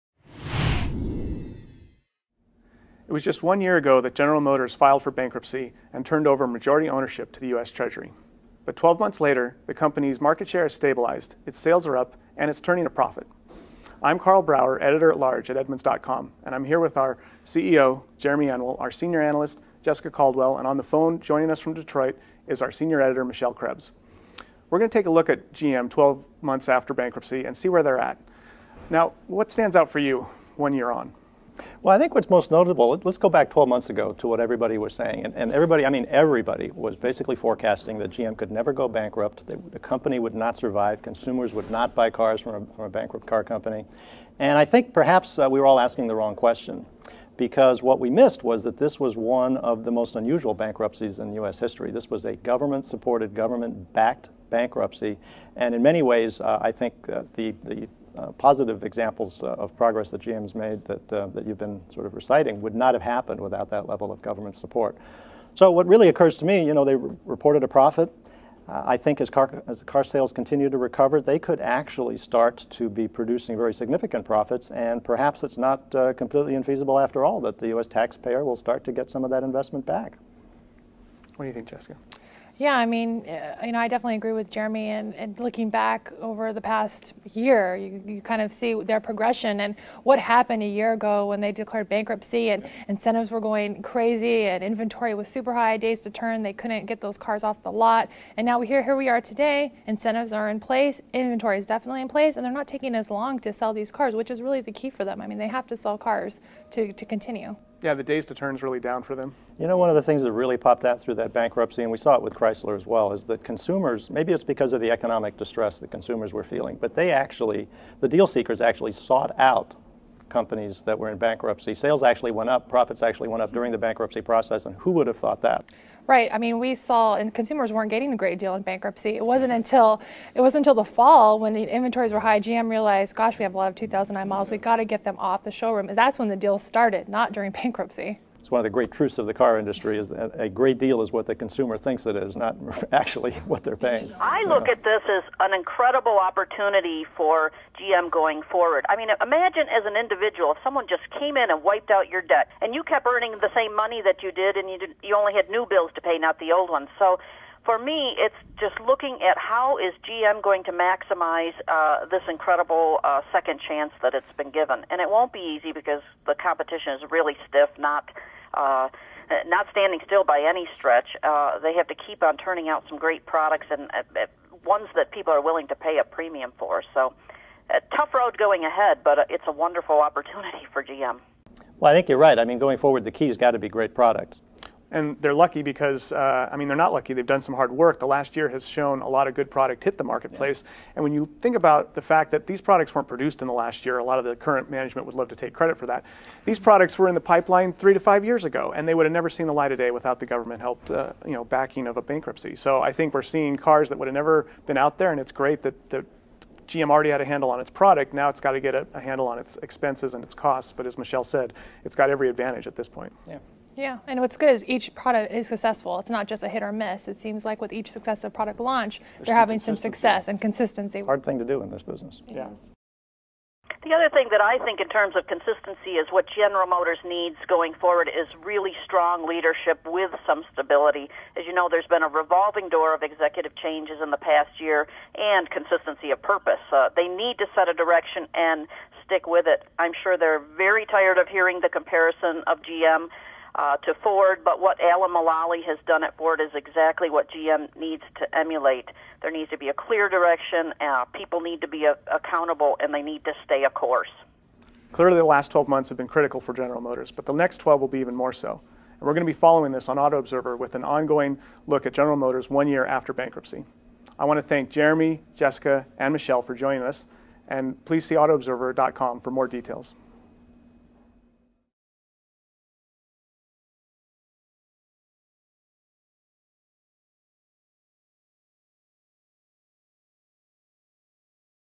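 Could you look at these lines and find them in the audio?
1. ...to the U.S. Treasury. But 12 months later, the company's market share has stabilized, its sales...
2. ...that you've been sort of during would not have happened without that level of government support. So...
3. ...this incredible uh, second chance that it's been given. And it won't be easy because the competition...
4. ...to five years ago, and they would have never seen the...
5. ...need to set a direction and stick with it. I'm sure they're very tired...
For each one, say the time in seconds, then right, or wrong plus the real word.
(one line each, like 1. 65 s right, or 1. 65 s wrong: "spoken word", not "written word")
1. 7 s right
2. 61 s wrong: "reciting", not "during"
3. 162 s right
4. 197 s right
5. 237 s right.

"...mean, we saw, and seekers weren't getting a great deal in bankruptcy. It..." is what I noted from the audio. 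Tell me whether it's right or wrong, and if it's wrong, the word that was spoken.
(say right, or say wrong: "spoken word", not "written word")
wrong: "consumers", not "seekers".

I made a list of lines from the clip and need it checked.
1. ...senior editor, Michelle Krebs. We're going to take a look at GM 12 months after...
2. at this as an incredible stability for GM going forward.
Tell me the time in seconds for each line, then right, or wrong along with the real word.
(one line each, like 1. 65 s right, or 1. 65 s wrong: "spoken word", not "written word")
1. 22 s right
2. 144 s wrong: "opportunity", not "stability".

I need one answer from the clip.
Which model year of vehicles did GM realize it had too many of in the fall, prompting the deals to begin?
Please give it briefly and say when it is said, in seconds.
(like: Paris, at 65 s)
2009, at 133 s.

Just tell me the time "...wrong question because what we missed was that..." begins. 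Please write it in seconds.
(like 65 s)
46 s.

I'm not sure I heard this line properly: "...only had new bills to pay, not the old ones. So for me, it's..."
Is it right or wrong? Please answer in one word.
right.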